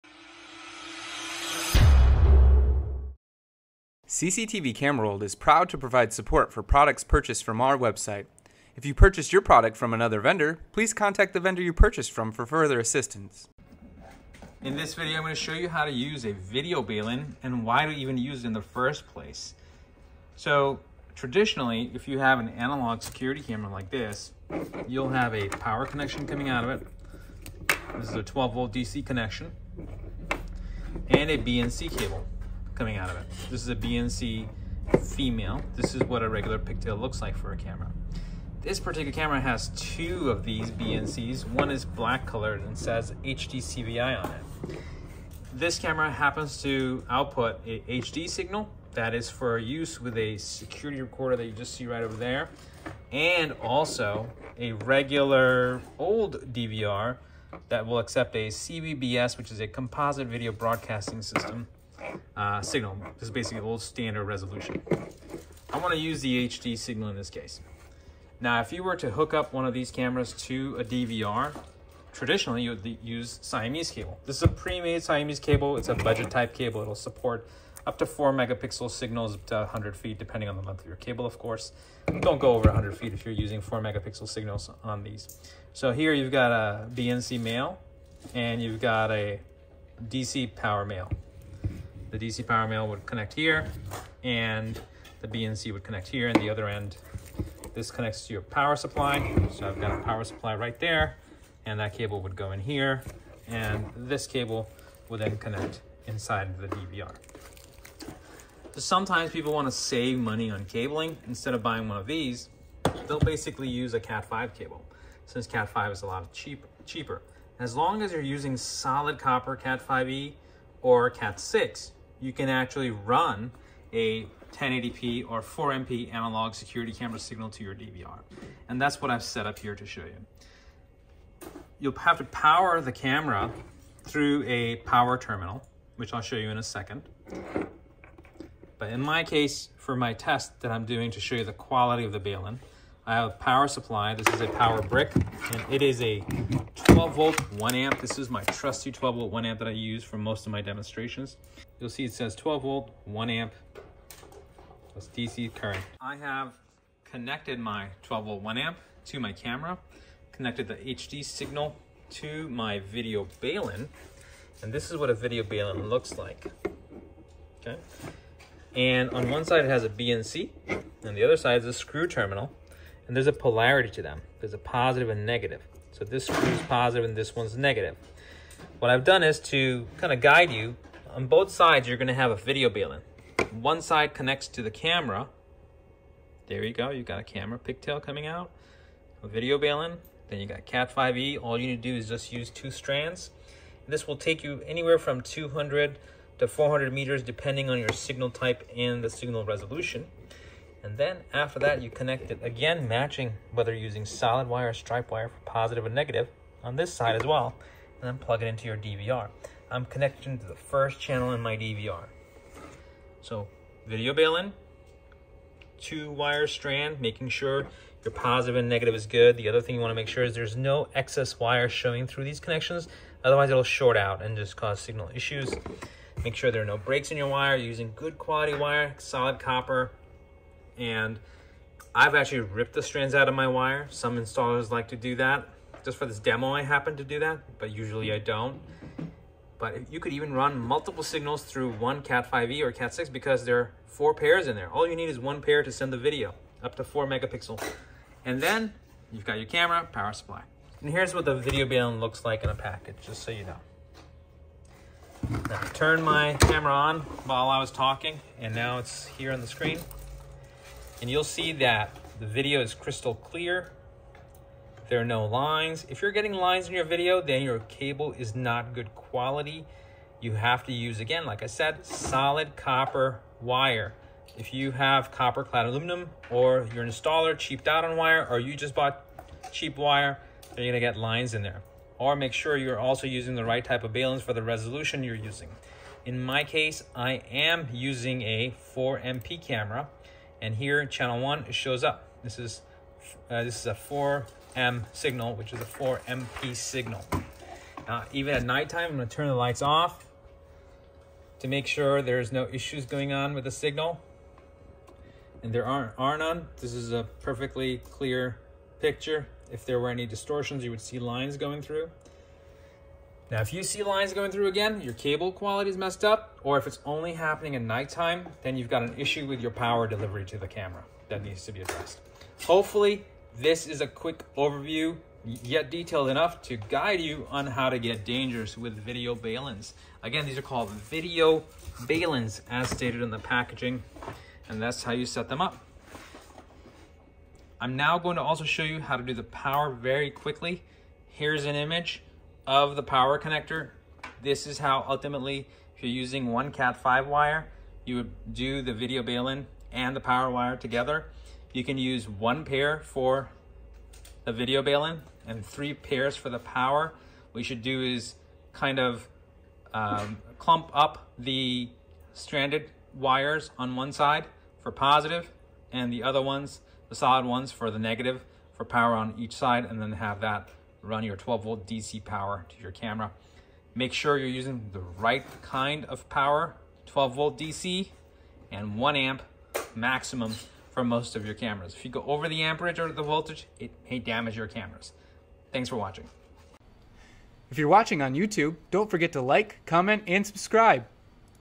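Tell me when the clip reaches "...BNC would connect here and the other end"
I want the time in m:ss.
1:35.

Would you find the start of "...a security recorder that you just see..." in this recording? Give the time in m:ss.
0:50.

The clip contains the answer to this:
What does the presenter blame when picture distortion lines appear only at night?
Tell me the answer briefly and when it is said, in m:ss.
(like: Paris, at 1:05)
power delivery, at 5:19.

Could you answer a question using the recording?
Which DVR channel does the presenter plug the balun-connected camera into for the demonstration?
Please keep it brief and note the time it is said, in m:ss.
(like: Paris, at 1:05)
first channel, at 3:30.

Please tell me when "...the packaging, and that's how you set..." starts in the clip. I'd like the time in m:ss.
5:33.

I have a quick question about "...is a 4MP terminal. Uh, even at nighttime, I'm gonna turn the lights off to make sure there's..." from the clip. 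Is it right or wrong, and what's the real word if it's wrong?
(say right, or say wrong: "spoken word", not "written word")
wrong: "signal", not "terminal".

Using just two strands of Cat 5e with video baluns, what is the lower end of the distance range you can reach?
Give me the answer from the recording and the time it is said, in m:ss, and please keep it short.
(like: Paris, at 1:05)
200 meters, at 3:15.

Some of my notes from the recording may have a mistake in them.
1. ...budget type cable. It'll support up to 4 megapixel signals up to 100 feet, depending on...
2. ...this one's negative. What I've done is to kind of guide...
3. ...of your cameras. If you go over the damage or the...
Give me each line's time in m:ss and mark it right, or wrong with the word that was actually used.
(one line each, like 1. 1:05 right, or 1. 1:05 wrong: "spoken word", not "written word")
1. 1:15 right
2. 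2:57 right
3. 6:21 wrong: "amperage", not "damage".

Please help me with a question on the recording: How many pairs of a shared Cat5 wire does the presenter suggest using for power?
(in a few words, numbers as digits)
3.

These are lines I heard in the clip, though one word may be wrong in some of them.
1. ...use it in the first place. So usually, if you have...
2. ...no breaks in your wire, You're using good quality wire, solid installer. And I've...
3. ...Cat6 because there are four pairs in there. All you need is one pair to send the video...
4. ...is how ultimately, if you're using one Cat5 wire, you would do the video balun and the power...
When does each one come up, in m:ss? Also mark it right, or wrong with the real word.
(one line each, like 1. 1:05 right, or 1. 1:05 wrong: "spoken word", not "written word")
1. 0:18 wrong: "traditionally", not "usually"
2. 3:46 wrong: "copper", not "installer"
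3. 4:02 right
4. 5:44 right.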